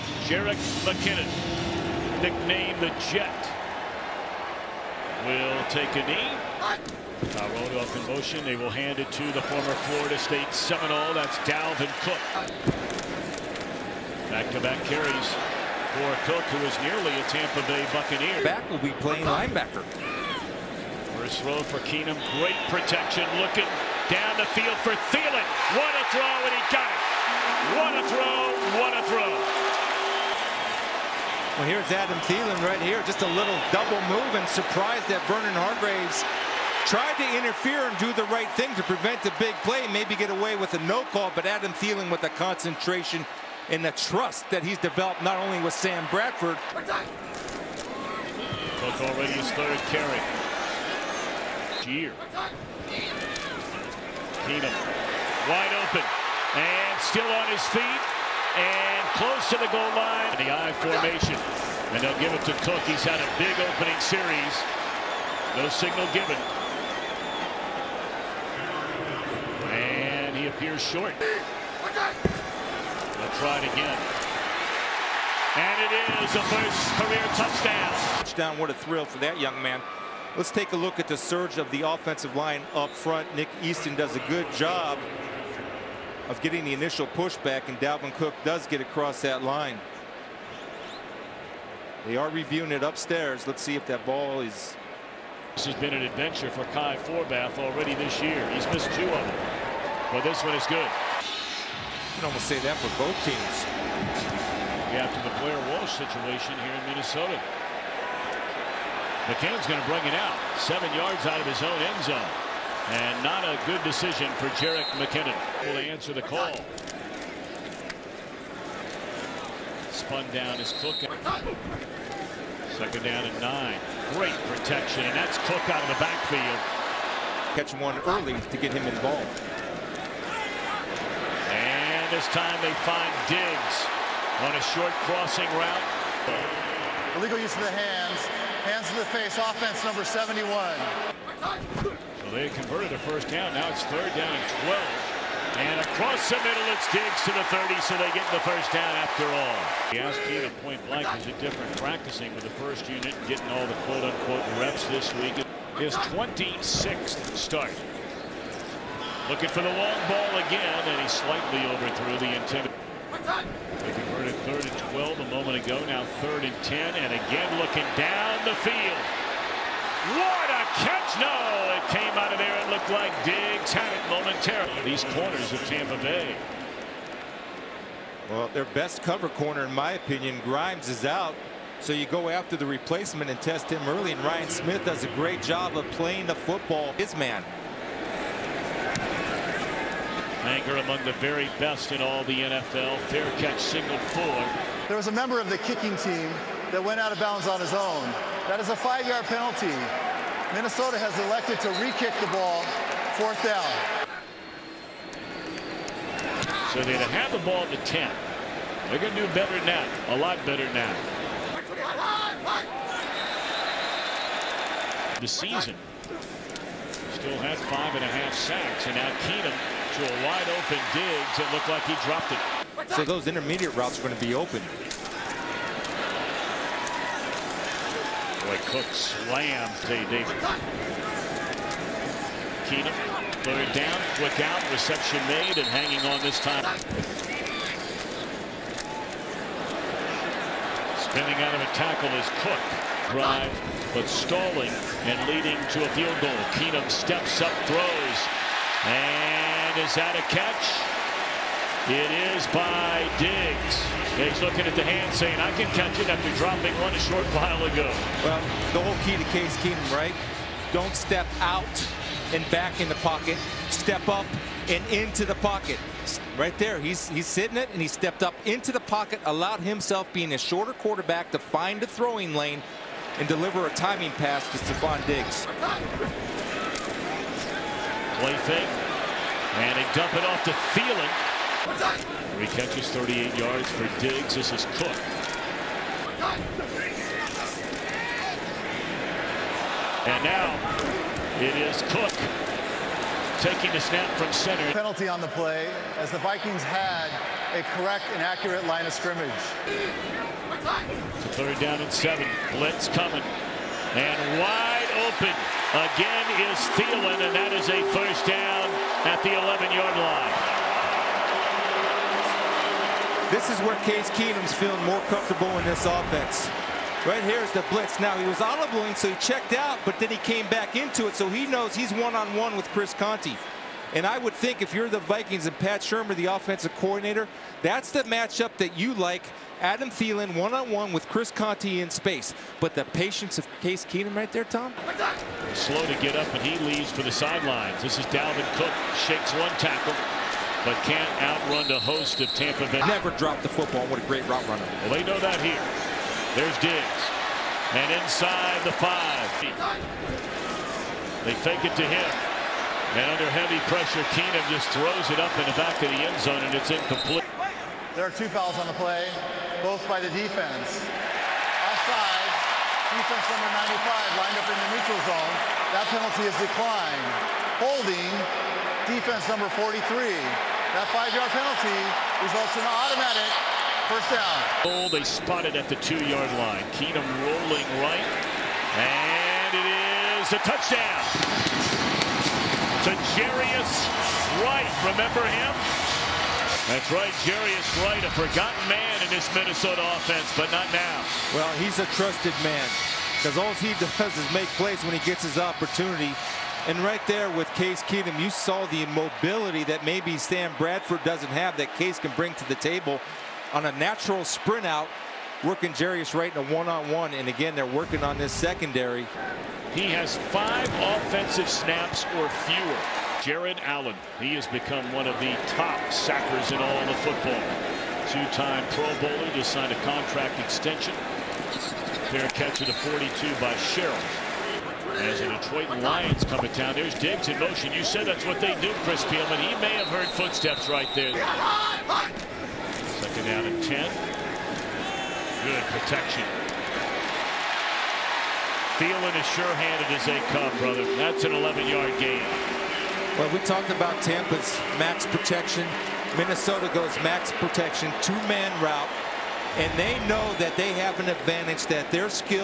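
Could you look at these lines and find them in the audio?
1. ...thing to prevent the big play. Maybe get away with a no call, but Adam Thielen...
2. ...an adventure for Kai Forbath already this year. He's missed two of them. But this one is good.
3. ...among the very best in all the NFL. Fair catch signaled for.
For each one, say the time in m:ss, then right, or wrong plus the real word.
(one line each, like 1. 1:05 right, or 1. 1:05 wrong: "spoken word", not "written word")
1. 0:38 right
2. 1:35 right
3. 3:10 right.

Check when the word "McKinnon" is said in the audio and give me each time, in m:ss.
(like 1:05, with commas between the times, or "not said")
0:00, 1:54.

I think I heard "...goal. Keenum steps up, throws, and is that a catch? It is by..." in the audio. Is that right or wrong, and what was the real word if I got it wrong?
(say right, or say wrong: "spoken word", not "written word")
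right.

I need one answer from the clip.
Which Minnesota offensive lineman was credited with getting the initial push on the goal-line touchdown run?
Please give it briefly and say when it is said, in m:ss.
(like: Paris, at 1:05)
Nick Easton, at 1:23.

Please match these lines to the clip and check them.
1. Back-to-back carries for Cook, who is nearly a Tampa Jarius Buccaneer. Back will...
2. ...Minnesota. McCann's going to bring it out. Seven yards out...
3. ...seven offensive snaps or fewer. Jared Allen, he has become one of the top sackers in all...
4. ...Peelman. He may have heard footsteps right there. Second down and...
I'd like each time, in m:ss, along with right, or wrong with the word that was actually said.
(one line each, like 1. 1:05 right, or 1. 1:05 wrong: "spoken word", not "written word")
1. 0:14 wrong: "Bay", not "Jarius"
2. 1:46 right
3. 6:50 wrong: "five", not "seven"
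4. 7:09 right.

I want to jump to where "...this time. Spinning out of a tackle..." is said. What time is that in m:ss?
3:56.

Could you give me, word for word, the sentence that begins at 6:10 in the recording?
That five-yard penalty results in an automatic first down.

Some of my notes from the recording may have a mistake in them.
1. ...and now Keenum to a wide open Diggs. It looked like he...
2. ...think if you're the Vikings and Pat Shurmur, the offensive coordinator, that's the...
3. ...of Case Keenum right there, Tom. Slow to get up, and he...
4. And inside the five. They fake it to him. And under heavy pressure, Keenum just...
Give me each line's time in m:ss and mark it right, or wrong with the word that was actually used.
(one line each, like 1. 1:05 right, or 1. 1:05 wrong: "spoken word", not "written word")
1. 3:38 right
2. 5:24 right
3. 5:33 right
4. 5:47 right.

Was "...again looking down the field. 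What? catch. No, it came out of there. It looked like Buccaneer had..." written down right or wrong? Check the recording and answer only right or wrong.
wrong.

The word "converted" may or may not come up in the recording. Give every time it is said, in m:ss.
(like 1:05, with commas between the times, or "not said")
2:22, 2:43.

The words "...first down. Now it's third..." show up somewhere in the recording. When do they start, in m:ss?
2:23.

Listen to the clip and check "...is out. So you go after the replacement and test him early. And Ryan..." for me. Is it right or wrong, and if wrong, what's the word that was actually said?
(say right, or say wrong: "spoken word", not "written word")
right.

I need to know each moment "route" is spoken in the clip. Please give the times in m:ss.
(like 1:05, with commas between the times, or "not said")
2:15, 3:43, 5:44, 7:28.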